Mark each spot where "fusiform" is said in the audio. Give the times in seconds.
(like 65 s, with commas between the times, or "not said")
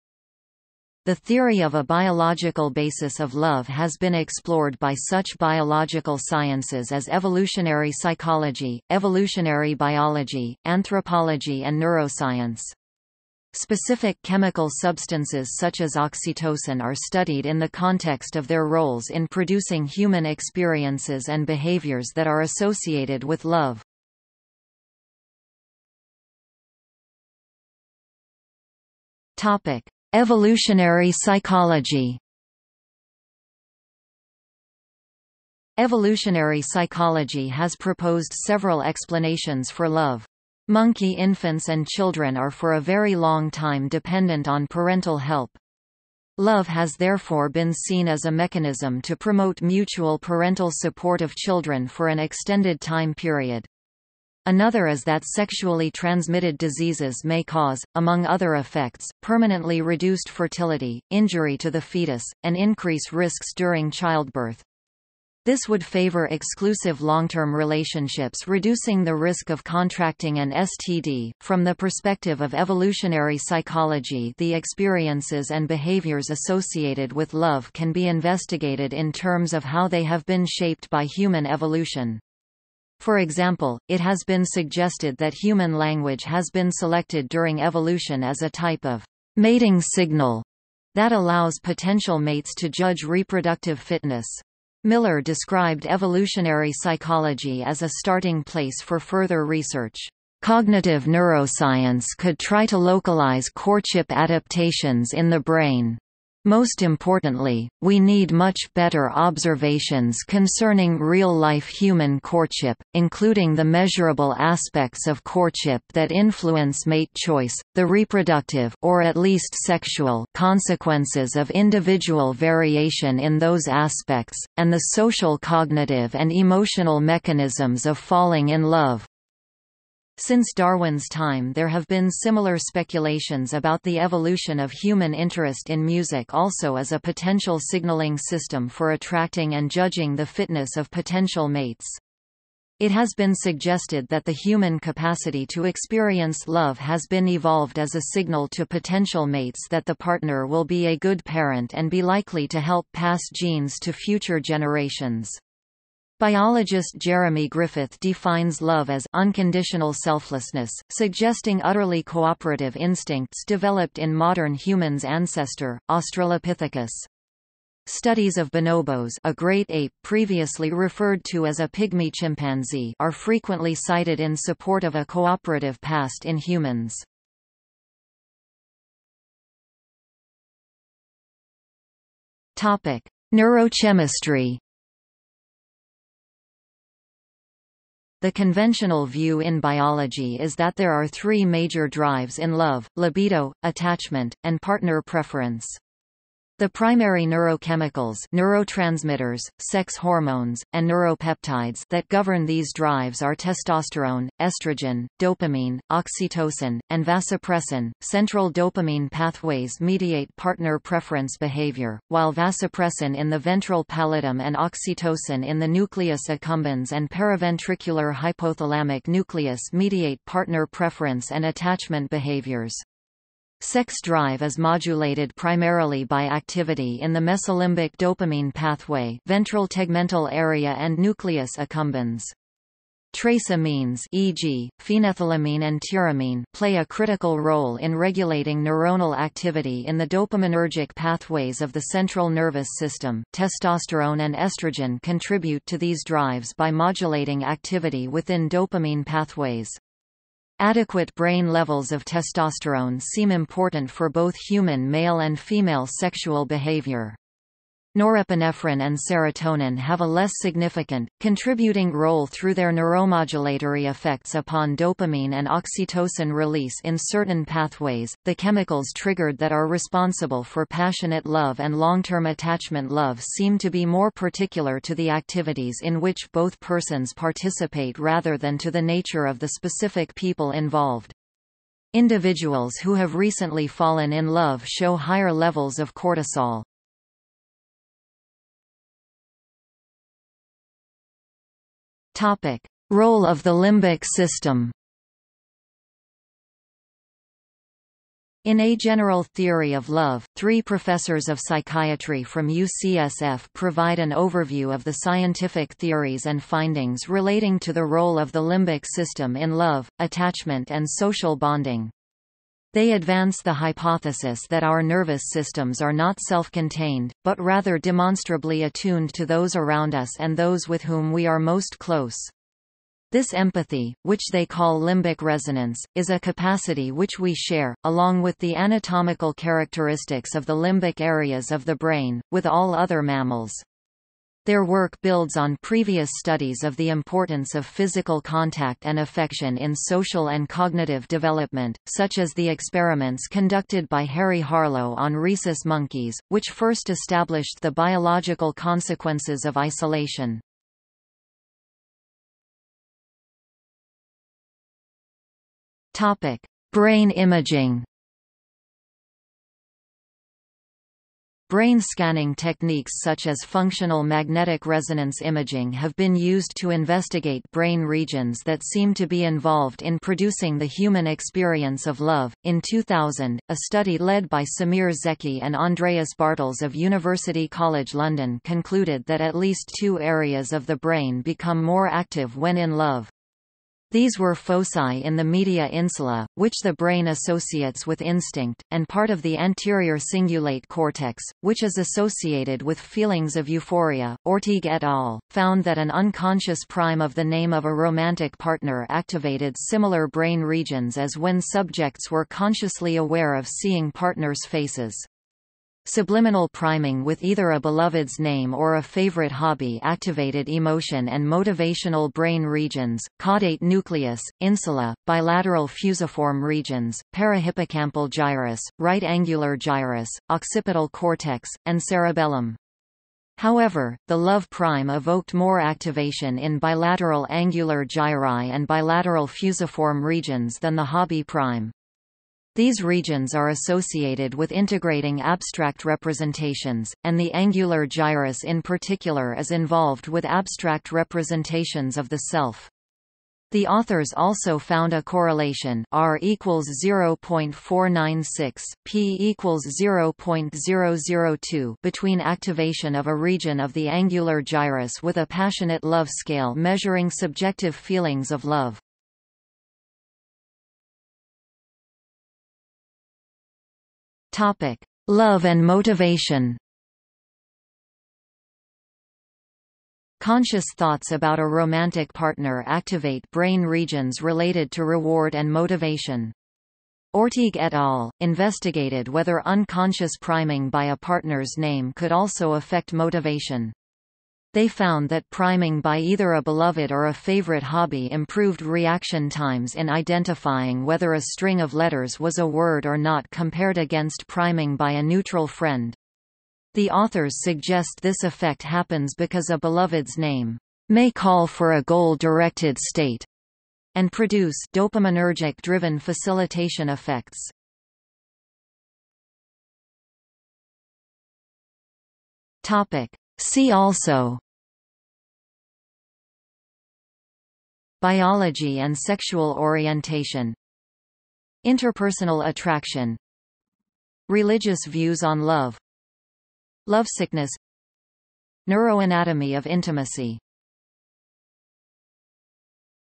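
415 s, 429 s.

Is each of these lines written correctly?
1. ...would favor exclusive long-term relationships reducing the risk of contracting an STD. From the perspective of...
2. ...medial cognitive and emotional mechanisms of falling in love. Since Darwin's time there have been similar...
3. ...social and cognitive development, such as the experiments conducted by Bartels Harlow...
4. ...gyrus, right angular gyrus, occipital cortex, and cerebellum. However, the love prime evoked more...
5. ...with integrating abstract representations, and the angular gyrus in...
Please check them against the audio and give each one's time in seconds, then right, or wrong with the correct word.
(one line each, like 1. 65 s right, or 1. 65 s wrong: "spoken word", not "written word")
1. 65 s right
2. 124 s wrong: "social", not "medial"
3. 339 s wrong: "Harry", not "Bartels"
4. 418 s right
5. 434 s right.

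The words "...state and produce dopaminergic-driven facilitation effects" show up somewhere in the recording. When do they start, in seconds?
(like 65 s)
502 s.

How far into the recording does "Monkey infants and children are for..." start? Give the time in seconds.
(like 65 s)
40 s.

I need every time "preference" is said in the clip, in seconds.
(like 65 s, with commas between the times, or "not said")
195 s, 210 s, 220 s.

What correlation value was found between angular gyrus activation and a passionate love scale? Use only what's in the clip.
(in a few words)
0.496.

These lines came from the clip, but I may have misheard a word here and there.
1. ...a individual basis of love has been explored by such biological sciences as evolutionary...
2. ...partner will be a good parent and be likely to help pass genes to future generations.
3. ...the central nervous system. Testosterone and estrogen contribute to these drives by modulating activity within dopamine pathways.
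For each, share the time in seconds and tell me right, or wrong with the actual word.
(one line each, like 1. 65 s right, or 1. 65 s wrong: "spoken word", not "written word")
1. 1 s wrong: "biological", not "individual"
2. 149 s right
3. 241 s right.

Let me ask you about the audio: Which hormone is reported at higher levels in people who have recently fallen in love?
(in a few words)
cortisol.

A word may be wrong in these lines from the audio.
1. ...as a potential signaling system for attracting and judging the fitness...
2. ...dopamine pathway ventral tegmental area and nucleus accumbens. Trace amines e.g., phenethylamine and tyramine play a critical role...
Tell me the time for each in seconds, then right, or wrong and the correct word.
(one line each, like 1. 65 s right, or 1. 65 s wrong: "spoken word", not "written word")
1. 136 s right
2. 227 s right.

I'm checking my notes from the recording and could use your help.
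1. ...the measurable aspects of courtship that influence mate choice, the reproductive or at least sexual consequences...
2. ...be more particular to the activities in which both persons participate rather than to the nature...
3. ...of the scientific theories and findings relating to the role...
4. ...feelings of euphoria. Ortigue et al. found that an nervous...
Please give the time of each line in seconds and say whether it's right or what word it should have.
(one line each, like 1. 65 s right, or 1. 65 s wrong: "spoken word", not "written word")
1. 113 s right
2. 273 s right
3. 304 s right
4. 392 s wrong: "unconscious", not "nervous".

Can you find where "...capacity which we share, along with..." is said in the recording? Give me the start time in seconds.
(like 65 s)
326 s.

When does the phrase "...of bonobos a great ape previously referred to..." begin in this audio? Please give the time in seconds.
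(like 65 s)
168 s.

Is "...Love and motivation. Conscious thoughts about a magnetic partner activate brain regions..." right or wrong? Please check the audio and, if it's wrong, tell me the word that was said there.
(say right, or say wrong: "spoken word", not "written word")
wrong: "romantic", not "magnetic".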